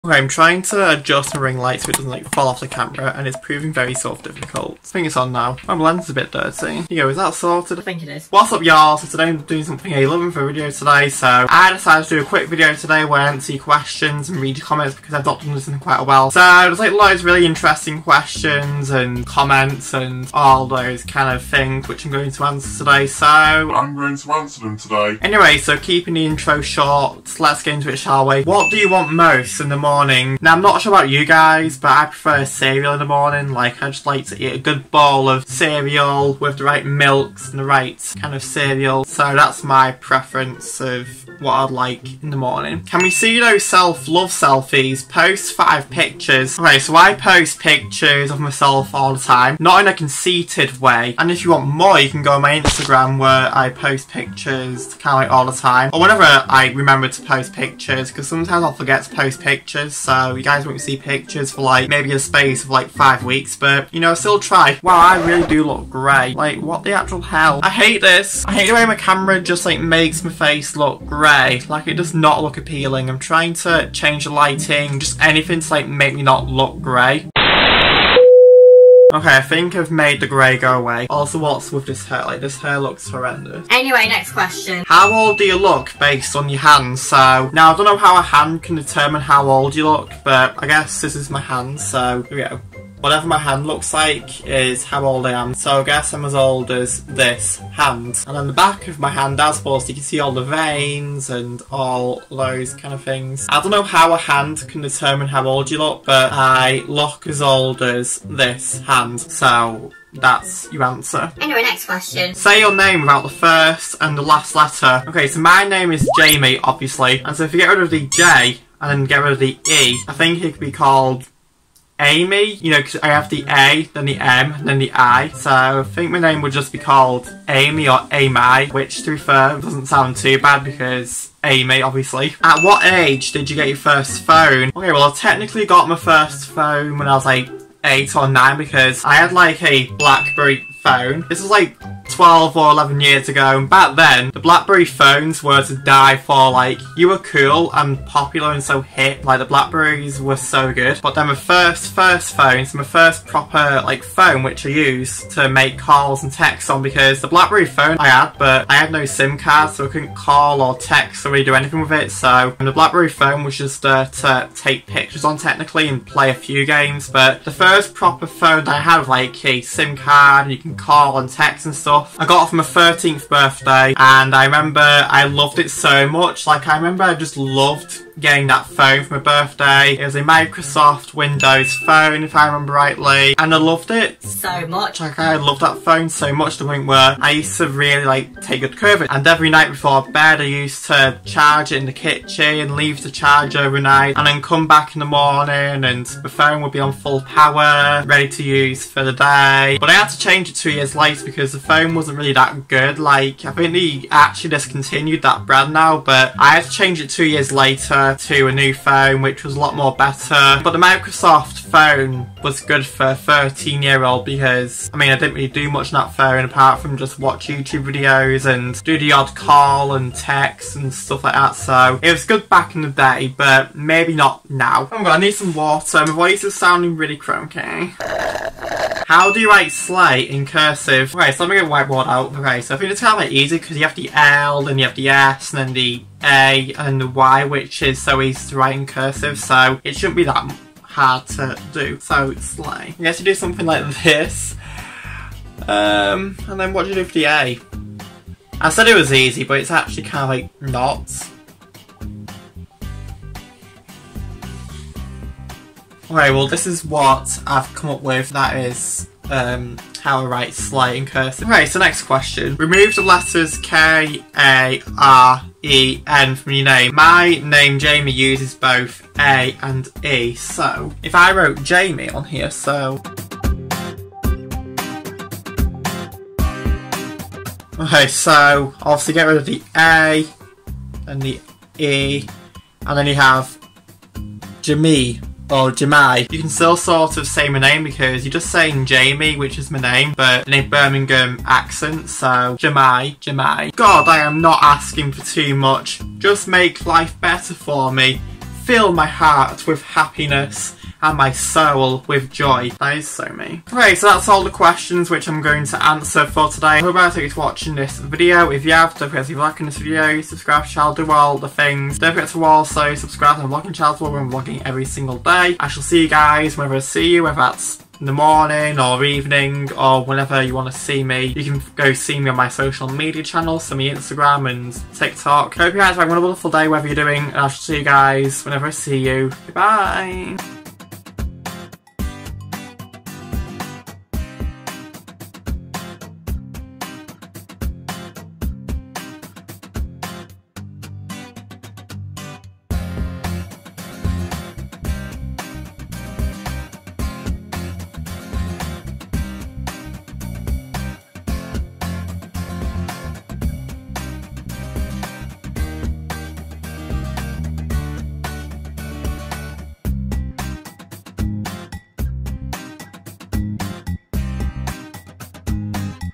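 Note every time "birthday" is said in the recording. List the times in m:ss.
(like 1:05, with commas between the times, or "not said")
2:53, 2:59.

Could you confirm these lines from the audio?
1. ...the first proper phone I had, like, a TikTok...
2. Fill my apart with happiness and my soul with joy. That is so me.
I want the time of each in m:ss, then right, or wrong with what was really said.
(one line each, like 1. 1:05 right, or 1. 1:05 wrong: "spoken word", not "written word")
1. 2:47 wrong: "SIM", not "TikTok"
2. 4:58 wrong: "heart", not "apart".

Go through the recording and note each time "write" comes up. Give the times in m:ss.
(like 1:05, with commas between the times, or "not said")
3:49, 3:58, 4:20.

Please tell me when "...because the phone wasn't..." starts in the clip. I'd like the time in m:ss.
3:21.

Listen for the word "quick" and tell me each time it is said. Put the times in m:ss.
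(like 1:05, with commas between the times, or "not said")
0:12.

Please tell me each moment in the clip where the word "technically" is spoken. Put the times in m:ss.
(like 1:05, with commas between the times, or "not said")
2:15, 2:45.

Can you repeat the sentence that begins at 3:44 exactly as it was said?
Oh my god I need some water my voice is sounding really croaky.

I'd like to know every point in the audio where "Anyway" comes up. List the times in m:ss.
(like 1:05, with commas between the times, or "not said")
0:25, 1:23, 1:51.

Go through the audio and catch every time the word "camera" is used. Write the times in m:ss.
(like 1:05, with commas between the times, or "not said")
0:02, 1:08.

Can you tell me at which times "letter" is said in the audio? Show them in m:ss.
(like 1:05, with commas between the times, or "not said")
1:54, 4:23.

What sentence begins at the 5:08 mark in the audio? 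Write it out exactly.
If you have, don't forget to like this video, subscribe to channel, do all the things.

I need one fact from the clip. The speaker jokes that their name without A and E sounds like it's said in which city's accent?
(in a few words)
Birmingham.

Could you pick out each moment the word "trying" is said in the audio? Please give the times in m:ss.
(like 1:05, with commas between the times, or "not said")
0:00, 1:13.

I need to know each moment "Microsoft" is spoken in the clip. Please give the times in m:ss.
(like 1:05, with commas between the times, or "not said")
3:00, 3:30.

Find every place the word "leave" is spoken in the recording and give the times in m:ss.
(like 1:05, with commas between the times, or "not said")
3:12.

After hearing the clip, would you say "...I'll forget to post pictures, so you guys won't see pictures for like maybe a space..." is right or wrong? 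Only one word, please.
right.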